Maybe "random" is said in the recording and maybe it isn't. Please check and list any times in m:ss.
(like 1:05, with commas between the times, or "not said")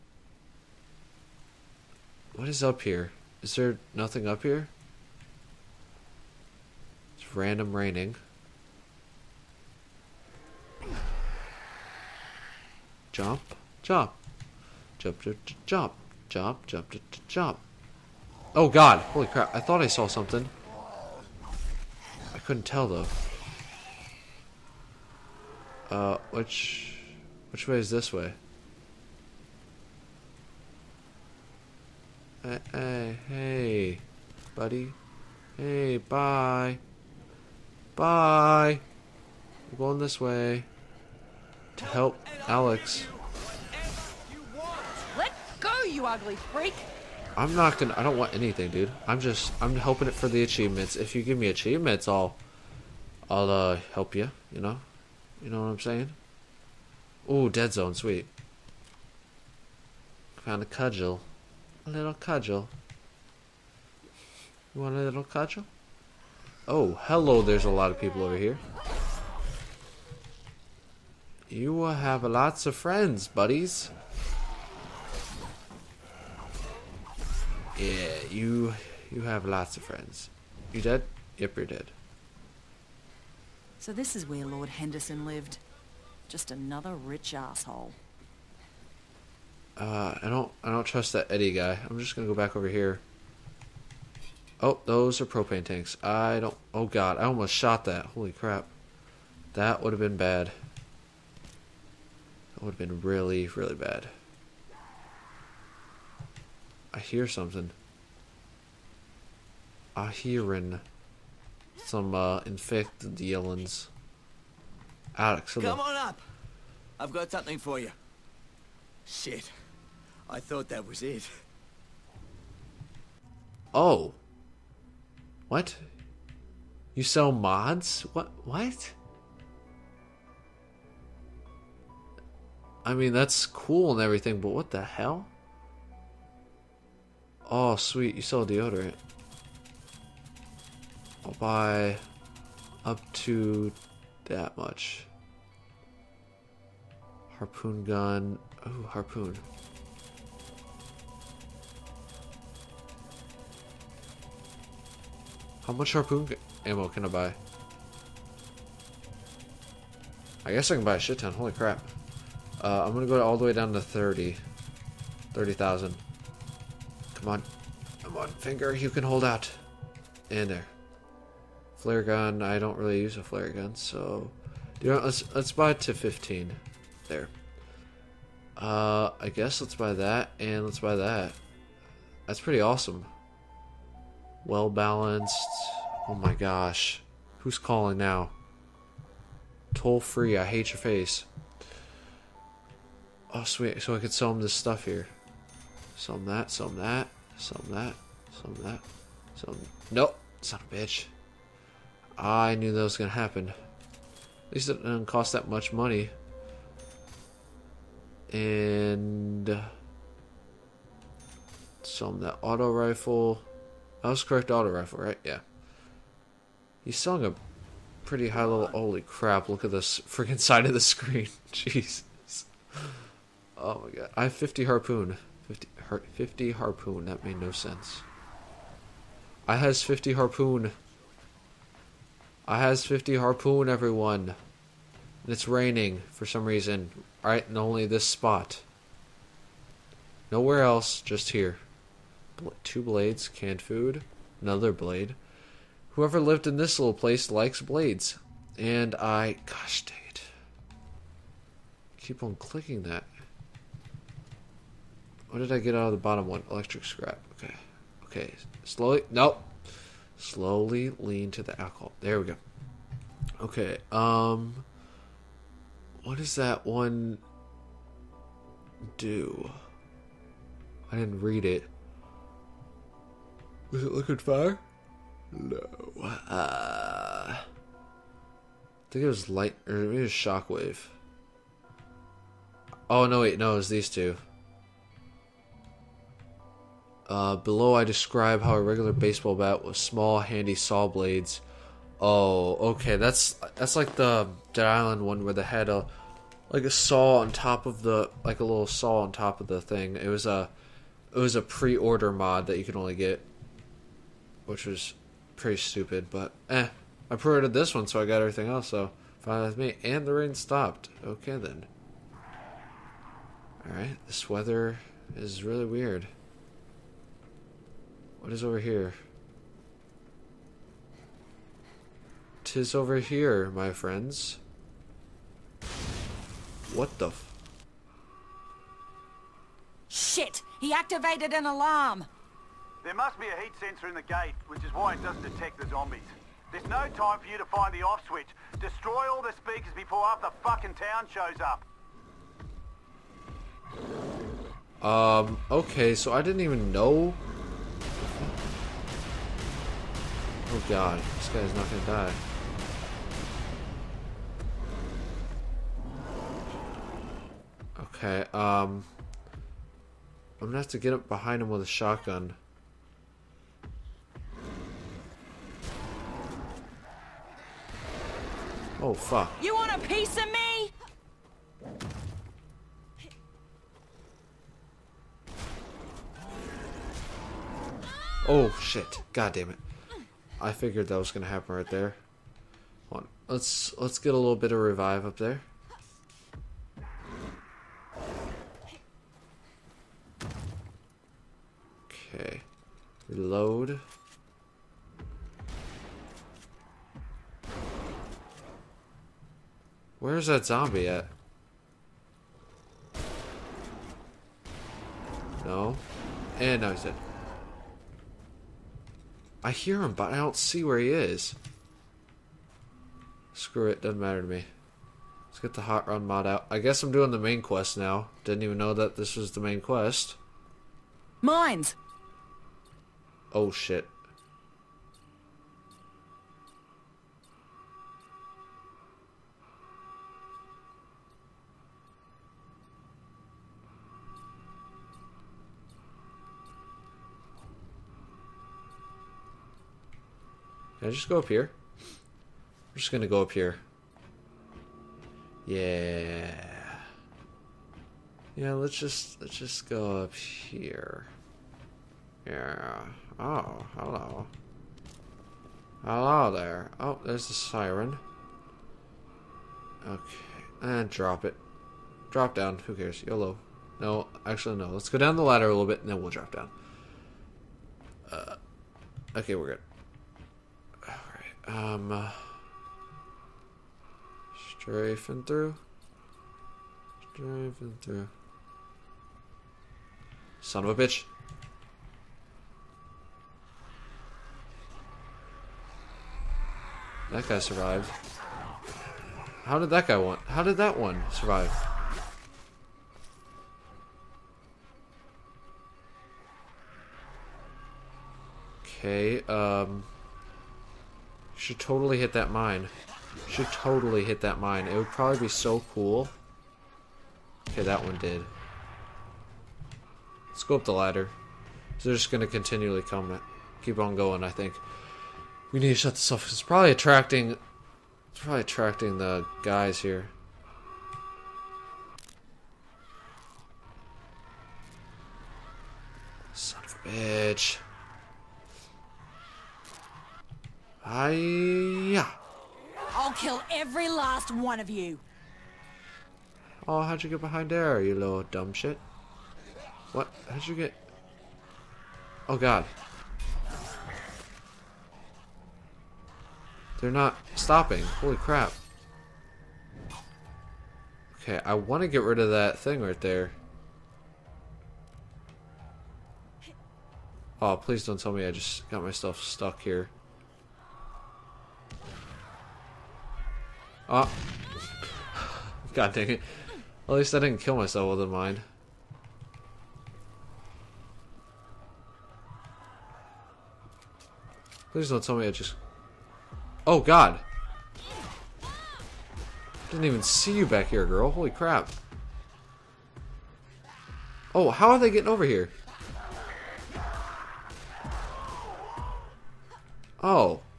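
0:07.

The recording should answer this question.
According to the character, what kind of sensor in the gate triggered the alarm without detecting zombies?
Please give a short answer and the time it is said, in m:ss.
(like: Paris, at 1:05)
Heat sensor, at 5:33.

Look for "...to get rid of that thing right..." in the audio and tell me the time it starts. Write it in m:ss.
9:11.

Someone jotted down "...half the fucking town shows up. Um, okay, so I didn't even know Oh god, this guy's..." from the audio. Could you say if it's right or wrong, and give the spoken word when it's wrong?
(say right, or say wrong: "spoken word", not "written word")
right.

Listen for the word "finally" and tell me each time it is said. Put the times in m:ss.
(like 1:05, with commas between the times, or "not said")
not said.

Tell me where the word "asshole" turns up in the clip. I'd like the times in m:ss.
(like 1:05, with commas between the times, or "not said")
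1:27.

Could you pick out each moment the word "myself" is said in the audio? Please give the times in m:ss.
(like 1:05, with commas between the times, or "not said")
9:18, 9:27.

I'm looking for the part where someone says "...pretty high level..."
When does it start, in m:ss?
3:38.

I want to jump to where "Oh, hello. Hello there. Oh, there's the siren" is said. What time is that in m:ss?
7:33.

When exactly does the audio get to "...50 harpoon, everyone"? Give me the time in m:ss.
3:52.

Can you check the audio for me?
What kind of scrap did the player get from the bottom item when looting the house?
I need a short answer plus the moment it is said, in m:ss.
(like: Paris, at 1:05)
Electric scrap, at 4:16.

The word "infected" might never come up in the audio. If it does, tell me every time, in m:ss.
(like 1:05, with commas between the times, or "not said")
1:52.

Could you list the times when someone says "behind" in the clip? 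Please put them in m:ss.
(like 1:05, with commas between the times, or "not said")
6:01, 8:57.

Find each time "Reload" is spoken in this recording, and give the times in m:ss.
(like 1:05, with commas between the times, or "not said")
6:33.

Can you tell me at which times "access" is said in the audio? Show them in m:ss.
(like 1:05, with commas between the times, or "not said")
not said.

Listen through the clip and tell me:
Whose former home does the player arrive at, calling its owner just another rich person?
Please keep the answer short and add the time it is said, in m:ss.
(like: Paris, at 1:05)
Lord Henderson, at 1:24.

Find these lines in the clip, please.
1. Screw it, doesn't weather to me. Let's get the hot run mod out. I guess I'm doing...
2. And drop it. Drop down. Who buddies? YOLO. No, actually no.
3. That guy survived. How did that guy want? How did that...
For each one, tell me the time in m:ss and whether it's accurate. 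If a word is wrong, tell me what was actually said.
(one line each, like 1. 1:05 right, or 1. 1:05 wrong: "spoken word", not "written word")
1. 6:53 wrong: "matter", not "weather"
2. 7:40 wrong: "cares", not "buddies"
3. 8:07 right.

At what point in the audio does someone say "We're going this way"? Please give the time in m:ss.
0:39.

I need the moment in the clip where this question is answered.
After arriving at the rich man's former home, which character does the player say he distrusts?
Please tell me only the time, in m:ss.
1:31.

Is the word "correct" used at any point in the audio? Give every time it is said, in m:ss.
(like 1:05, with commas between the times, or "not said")
3:34.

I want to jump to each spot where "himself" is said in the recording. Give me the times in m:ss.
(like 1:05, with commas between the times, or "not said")
not said.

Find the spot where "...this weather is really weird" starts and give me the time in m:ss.
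5:14.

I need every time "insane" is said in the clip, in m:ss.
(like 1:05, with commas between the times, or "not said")
not said.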